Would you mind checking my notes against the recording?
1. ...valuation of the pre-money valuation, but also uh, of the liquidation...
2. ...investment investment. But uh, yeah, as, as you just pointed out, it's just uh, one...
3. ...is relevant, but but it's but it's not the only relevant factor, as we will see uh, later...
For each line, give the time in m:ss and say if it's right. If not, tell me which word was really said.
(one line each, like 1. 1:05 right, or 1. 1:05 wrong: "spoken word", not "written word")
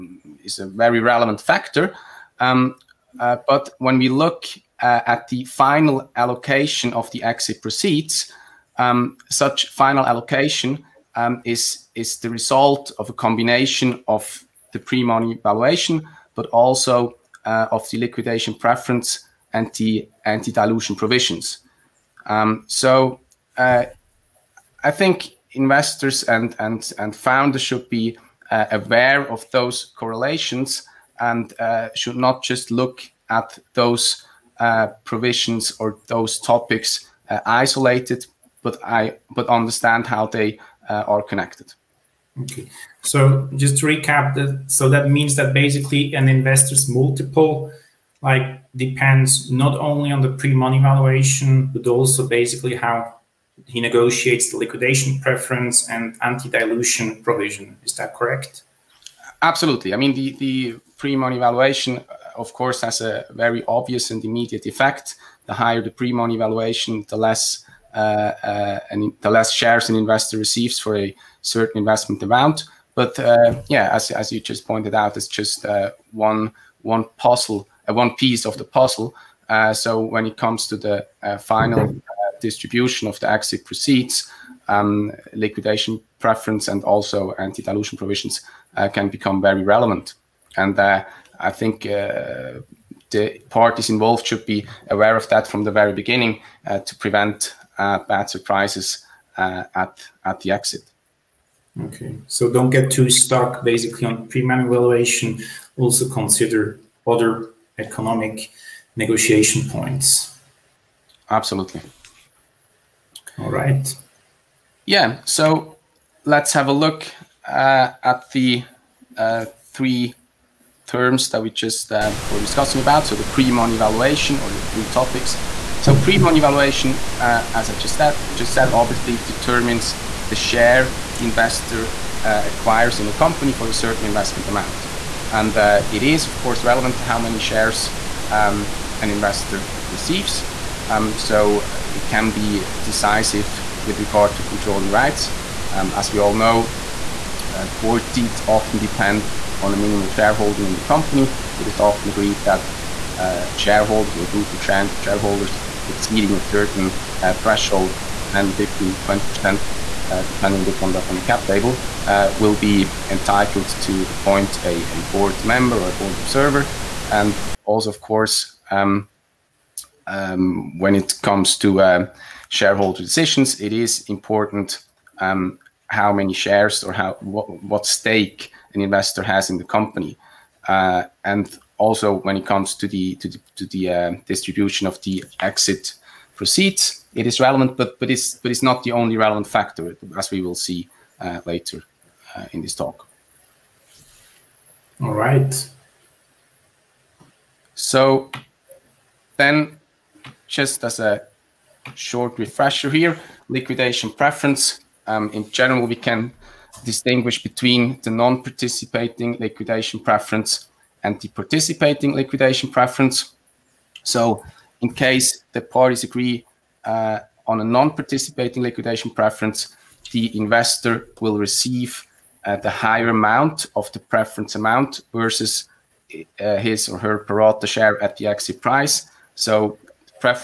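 1. 0:13 wrong: "combination", not "valuation"
2. 1:11 wrong: "amount", not "investment"
3. 3:07 right.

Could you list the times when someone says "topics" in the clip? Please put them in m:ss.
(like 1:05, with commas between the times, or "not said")
0:36, 2:04.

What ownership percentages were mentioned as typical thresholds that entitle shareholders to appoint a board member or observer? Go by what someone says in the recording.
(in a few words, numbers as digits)
10, 15, 20 percent.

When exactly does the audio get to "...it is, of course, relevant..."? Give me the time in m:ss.
2:15.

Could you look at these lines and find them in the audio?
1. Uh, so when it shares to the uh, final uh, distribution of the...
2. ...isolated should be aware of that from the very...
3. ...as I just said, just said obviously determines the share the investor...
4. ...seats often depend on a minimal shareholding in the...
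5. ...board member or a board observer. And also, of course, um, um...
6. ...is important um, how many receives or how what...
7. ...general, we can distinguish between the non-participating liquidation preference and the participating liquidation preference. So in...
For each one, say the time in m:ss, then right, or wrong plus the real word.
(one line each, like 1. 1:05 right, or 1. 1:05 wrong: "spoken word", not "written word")
1. 1:19 wrong: "comes", not "shares"
2. 1:33 wrong: "involved", not "isolated"
3. 2:07 right
4. 2:28 right
5. 2:45 right
6. 2:53 wrong: "shares", not "receives"
7. 3:25 right.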